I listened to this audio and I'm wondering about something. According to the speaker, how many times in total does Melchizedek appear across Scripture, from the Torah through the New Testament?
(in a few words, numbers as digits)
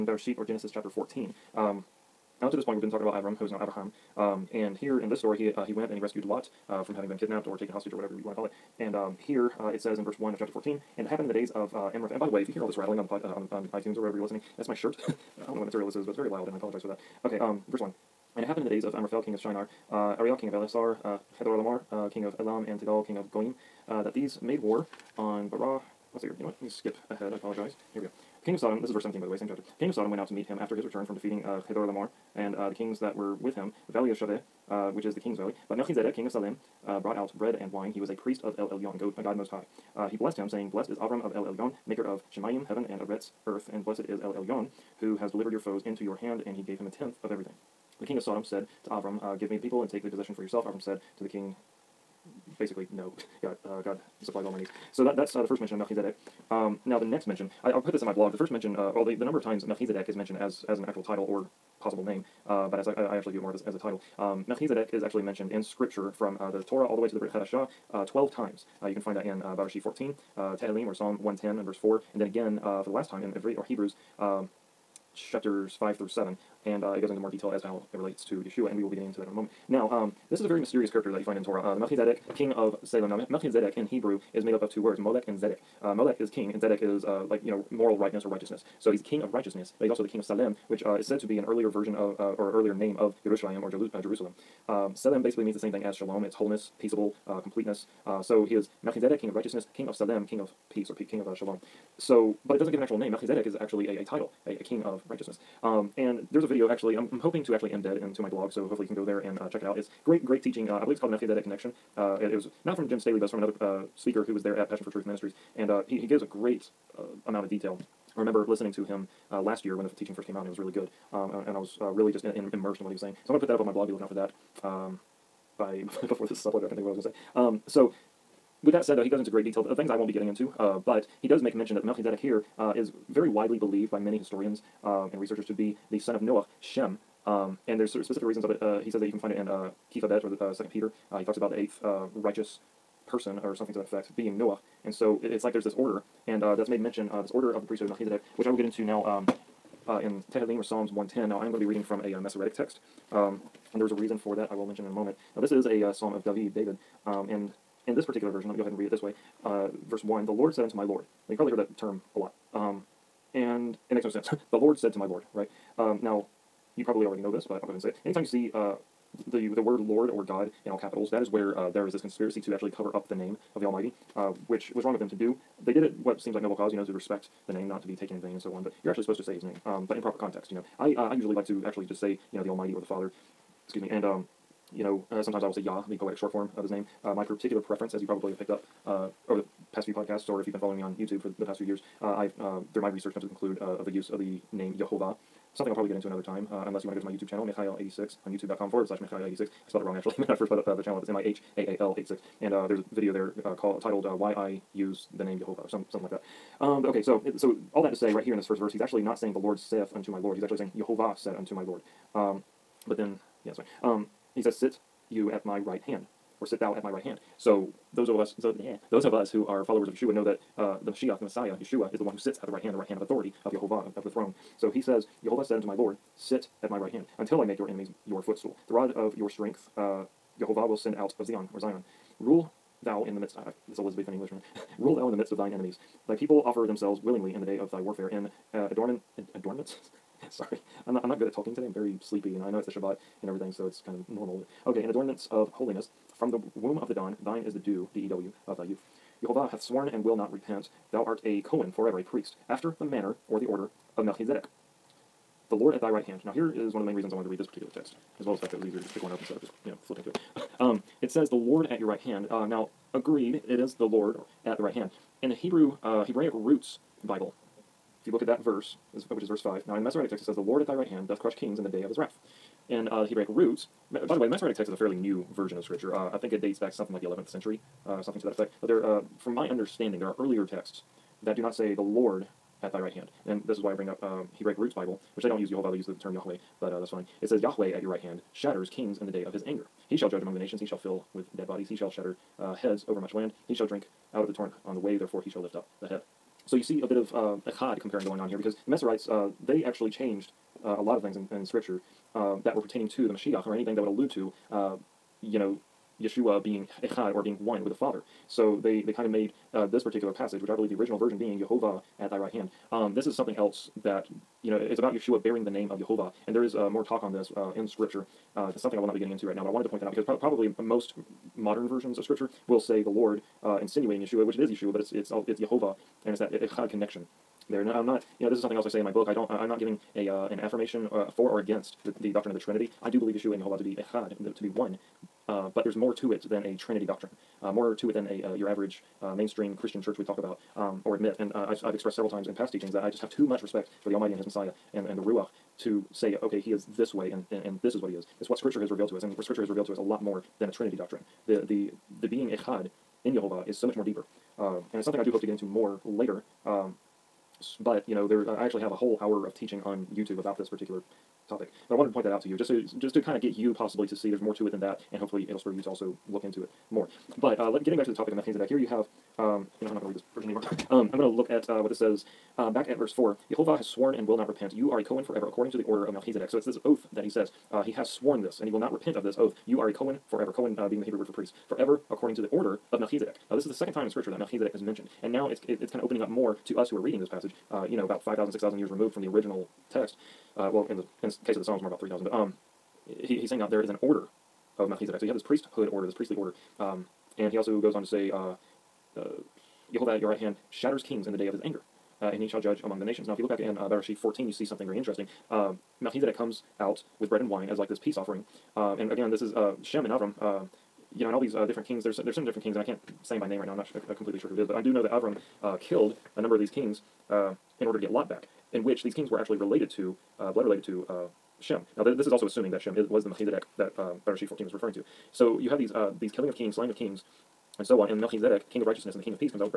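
12.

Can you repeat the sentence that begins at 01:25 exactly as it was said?
Uh, Molech is king, and Zedek is uh, like, you know, moral rightness or righteousness.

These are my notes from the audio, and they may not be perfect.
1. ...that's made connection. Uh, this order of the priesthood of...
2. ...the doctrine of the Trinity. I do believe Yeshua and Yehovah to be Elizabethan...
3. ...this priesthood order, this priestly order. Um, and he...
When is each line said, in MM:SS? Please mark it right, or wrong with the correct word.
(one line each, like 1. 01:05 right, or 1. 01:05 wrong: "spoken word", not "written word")
1. 02:26 wrong: "mention", not "connection"
2. 05:32 wrong: "Echad", not "Elizabethan"
3. 06:35 right.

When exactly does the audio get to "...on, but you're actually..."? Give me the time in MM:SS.
02:58.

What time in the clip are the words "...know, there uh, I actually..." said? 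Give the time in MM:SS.
05:57.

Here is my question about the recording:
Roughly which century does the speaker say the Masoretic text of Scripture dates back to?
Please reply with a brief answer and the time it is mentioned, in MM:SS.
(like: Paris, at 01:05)
11th century, at 04:37.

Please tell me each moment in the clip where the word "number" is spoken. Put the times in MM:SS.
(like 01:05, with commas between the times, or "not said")
00:59, 06:56.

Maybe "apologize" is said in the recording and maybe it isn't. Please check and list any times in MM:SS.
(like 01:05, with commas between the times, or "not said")
00:16, 00:27.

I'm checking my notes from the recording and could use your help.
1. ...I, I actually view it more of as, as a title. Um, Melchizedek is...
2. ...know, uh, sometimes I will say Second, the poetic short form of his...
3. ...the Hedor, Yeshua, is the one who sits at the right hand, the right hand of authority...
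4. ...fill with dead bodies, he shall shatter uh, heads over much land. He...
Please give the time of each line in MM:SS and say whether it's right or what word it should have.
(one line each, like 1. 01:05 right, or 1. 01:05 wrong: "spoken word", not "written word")
1. 01:02 right
2. 03:04 wrong: "Yah", not "Second"
3. 03:41 wrong: "Messiah", not "Hedor"
4. 04:50 right.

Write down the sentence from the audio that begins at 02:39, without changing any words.
Uh, verse 1 The Lord said unto my Lord.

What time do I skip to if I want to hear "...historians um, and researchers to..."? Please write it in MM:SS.
02:14.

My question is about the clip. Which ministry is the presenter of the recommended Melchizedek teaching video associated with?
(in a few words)
Passion for Truth Ministries.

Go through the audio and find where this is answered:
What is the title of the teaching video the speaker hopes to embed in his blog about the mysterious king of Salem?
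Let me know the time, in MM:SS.
01:51.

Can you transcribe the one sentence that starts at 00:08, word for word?
And um, here uh, it says in verse 1 of chapter 14, and it happened in the days of uh, Amraphel.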